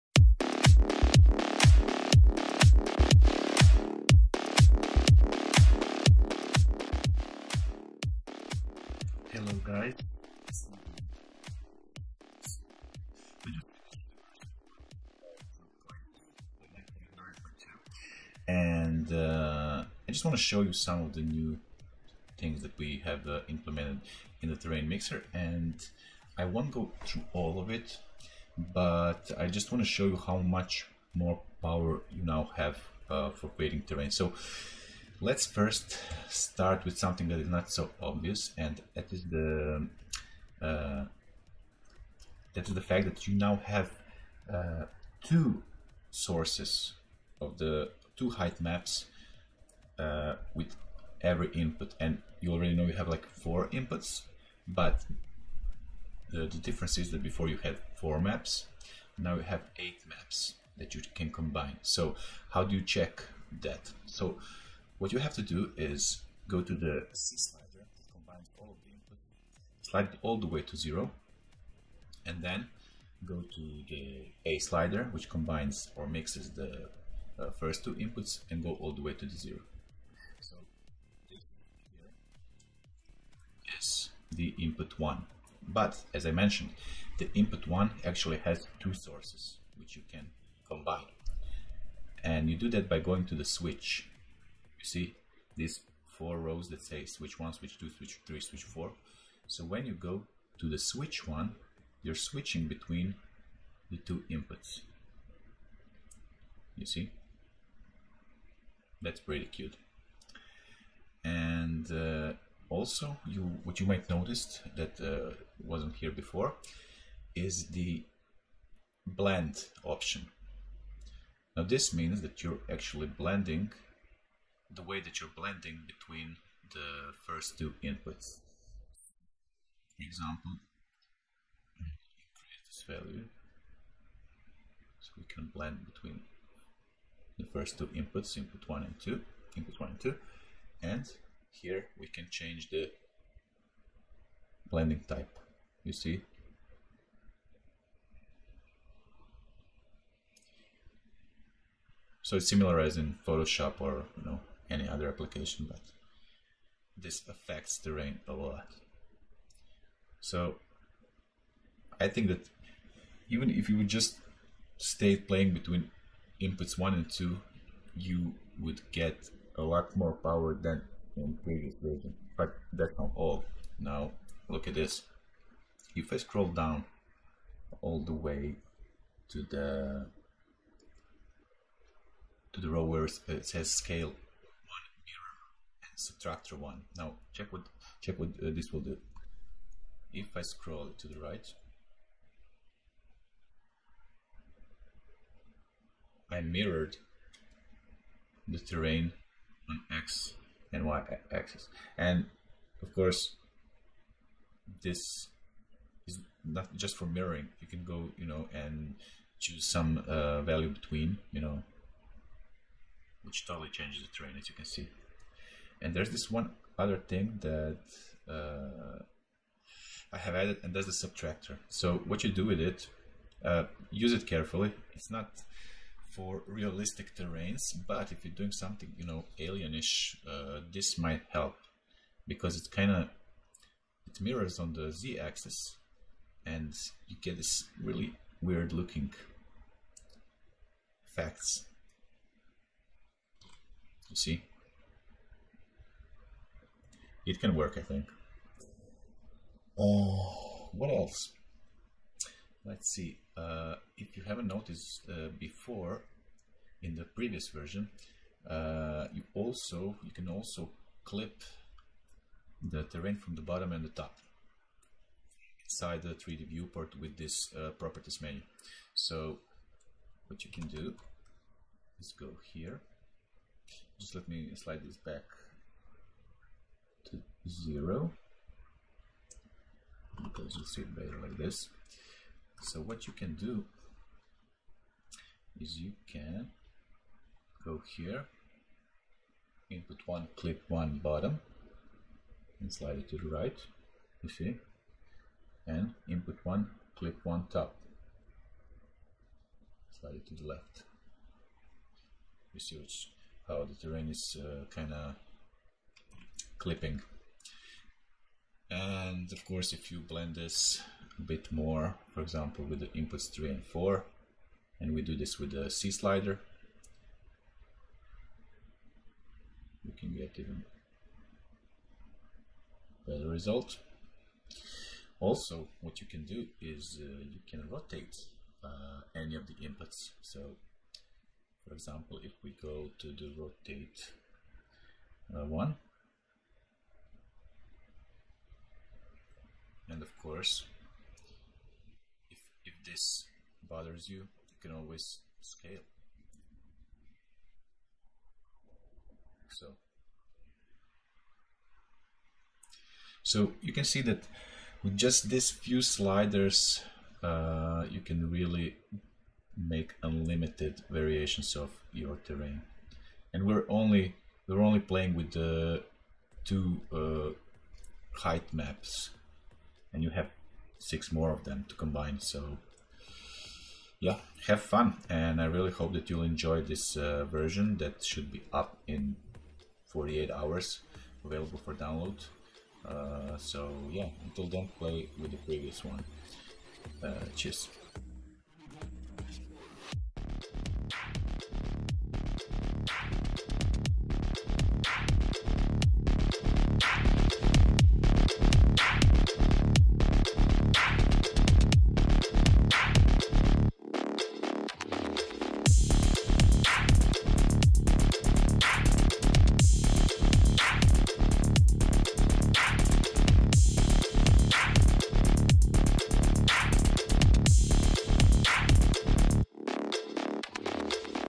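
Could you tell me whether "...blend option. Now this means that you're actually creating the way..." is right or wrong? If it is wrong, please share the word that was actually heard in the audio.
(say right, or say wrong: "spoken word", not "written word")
wrong: "blending", not "creating".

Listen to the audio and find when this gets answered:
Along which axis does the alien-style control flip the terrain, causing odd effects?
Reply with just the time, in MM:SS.
03:54.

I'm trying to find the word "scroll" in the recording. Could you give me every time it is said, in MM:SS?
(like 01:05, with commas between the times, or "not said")
02:56, 03:10.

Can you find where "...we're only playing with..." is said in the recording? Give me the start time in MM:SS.
06:04.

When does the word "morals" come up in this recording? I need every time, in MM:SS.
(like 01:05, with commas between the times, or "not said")
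not said.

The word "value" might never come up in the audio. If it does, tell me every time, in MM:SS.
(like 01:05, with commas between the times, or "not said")
02:12, 03:30.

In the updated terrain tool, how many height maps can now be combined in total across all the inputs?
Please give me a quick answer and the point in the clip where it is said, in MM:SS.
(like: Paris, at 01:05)
8, at 00:59.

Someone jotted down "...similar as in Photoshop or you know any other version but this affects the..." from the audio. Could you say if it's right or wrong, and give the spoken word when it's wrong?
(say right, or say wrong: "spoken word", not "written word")
wrong: "application", not "version".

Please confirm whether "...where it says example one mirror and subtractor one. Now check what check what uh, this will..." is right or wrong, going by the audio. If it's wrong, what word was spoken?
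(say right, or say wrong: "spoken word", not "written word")
wrong: "scale", not "example".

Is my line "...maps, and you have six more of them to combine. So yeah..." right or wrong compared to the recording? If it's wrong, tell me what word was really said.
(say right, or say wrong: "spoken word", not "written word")
right.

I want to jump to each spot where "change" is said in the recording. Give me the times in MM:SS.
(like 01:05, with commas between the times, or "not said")
02:22, 03:33.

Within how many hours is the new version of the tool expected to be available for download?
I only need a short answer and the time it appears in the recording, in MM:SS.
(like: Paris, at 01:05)
48, at 06:19.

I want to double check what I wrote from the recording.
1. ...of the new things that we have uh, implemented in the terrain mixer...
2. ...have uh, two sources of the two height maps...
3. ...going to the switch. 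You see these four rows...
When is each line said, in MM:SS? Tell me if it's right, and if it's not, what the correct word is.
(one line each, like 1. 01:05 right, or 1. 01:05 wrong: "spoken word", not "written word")
1. 00:21 right
2. 00:43 right
3. 01:32 right.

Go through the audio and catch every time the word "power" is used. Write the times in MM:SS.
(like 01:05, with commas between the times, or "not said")
00:31, 02:50.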